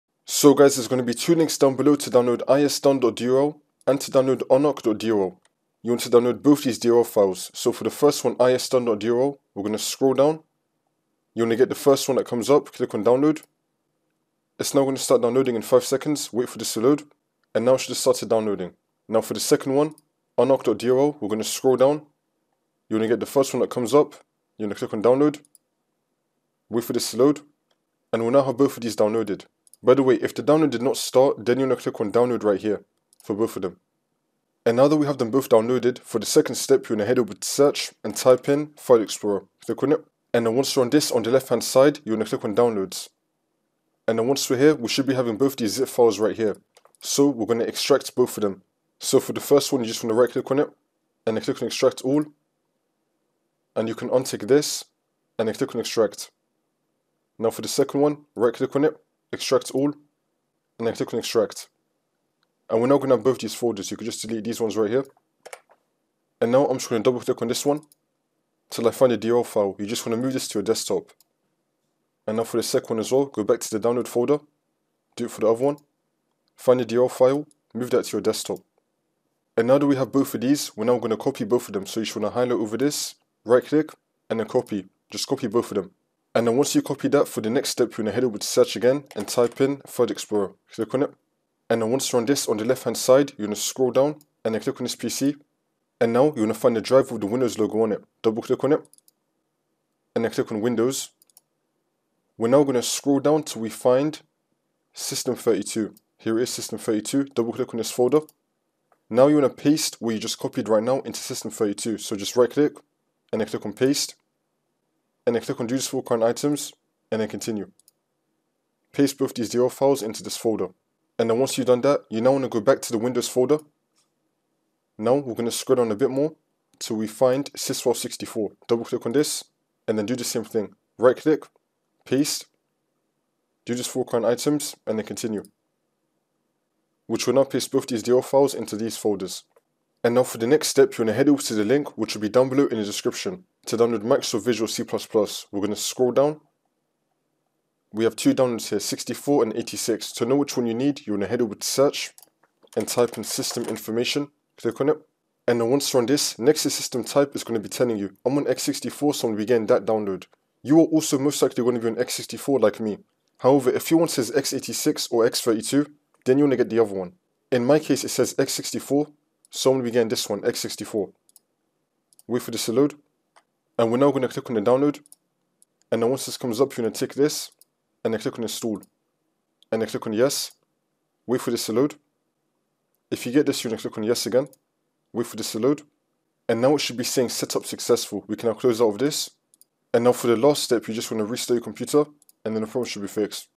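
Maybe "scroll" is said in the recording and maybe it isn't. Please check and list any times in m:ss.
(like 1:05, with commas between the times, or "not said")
0:09, 0:21, 1:33, 1:42, 2:05, 2:25.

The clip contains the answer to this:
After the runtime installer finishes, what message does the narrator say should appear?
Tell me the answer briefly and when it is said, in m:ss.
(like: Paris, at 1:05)
Setup successful, at 3:07.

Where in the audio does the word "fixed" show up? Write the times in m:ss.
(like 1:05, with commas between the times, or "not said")
3:13.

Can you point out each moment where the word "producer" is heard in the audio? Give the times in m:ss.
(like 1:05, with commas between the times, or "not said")
not said.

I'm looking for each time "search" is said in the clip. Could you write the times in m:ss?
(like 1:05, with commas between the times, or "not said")
0:37, 1:28, 2:31.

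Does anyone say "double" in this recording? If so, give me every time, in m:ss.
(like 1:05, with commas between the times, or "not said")
1:07, 1:38, 1:47, 2:08.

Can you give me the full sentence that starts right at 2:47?
In my case, it says x64, so I'm going to be getting this one, x64.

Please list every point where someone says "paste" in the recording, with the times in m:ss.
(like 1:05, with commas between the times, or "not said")
1:49, 1:53, 1:58, 2:12, 2:17.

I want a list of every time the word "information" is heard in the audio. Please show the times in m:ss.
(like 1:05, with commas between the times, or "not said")
2:33.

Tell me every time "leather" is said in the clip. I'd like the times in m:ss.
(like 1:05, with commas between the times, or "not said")
not said.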